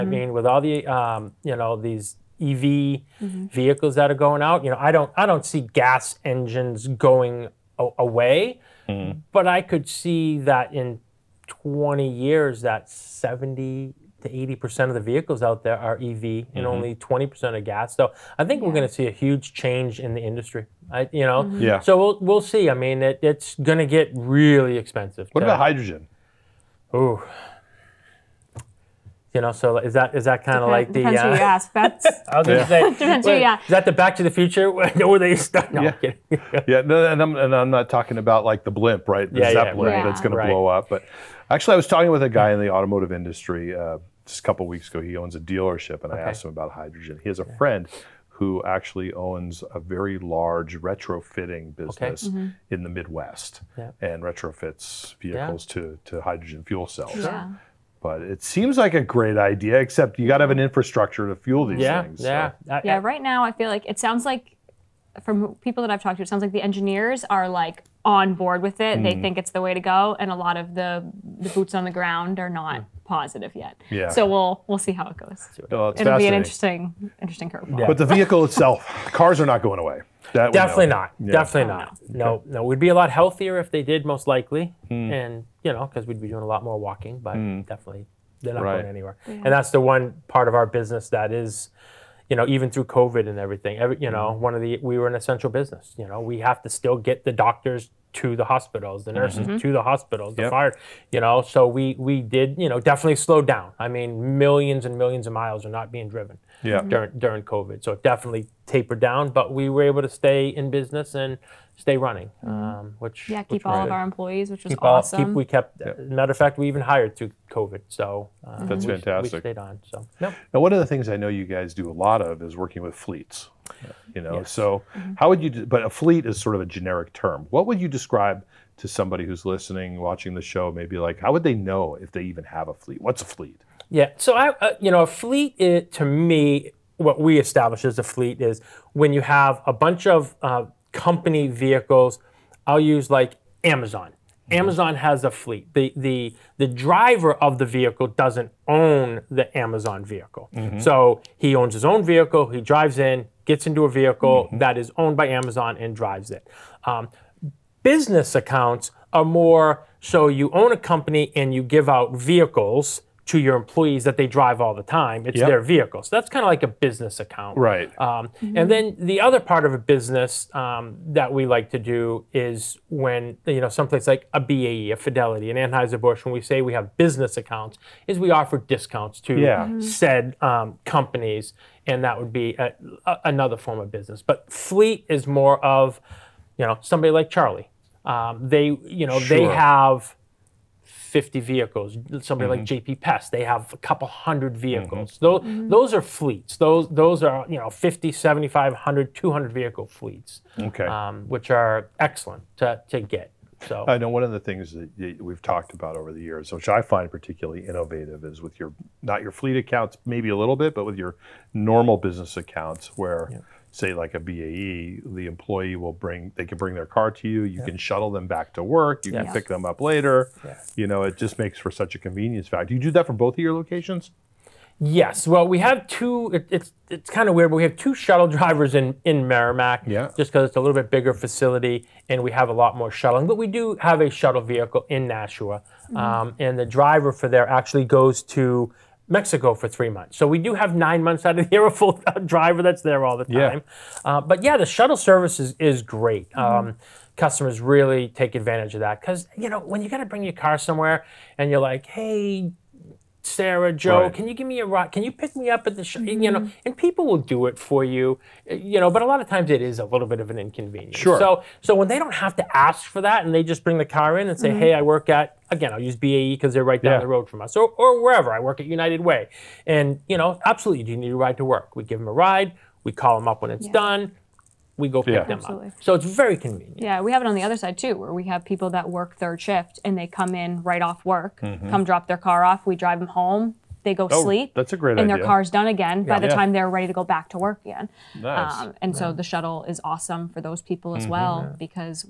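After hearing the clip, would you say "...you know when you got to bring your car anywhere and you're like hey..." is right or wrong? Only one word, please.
wrong.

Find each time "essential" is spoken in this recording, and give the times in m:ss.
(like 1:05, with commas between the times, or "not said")
1:35.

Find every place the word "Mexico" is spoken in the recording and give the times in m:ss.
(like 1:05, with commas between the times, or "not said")
3:59.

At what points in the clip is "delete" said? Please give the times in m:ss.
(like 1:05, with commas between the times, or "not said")
not said.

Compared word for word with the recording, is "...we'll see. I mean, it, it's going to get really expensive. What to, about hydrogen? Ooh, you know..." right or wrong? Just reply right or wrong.
right.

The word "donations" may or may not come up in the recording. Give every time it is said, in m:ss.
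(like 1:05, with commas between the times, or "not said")
not said.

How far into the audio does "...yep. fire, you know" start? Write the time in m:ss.
1:40.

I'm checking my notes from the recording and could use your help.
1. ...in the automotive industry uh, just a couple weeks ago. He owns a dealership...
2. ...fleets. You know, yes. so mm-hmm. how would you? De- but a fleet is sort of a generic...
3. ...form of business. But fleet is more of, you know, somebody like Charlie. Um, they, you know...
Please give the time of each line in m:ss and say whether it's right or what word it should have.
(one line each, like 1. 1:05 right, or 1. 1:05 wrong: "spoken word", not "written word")
1. 0:42 right
2. 2:02 right
3. 3:03 right.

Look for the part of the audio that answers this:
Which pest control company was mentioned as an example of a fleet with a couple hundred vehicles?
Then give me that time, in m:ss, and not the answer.
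3:12.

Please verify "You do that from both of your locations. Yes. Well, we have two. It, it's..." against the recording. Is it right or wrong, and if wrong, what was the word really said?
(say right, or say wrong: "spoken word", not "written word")
right.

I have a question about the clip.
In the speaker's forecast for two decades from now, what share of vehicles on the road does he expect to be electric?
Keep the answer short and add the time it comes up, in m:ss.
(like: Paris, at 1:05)
70 to 80%, at 0:12.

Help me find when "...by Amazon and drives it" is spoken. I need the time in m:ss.
2:35.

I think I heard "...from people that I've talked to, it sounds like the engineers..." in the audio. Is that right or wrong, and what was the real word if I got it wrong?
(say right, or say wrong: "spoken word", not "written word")
right.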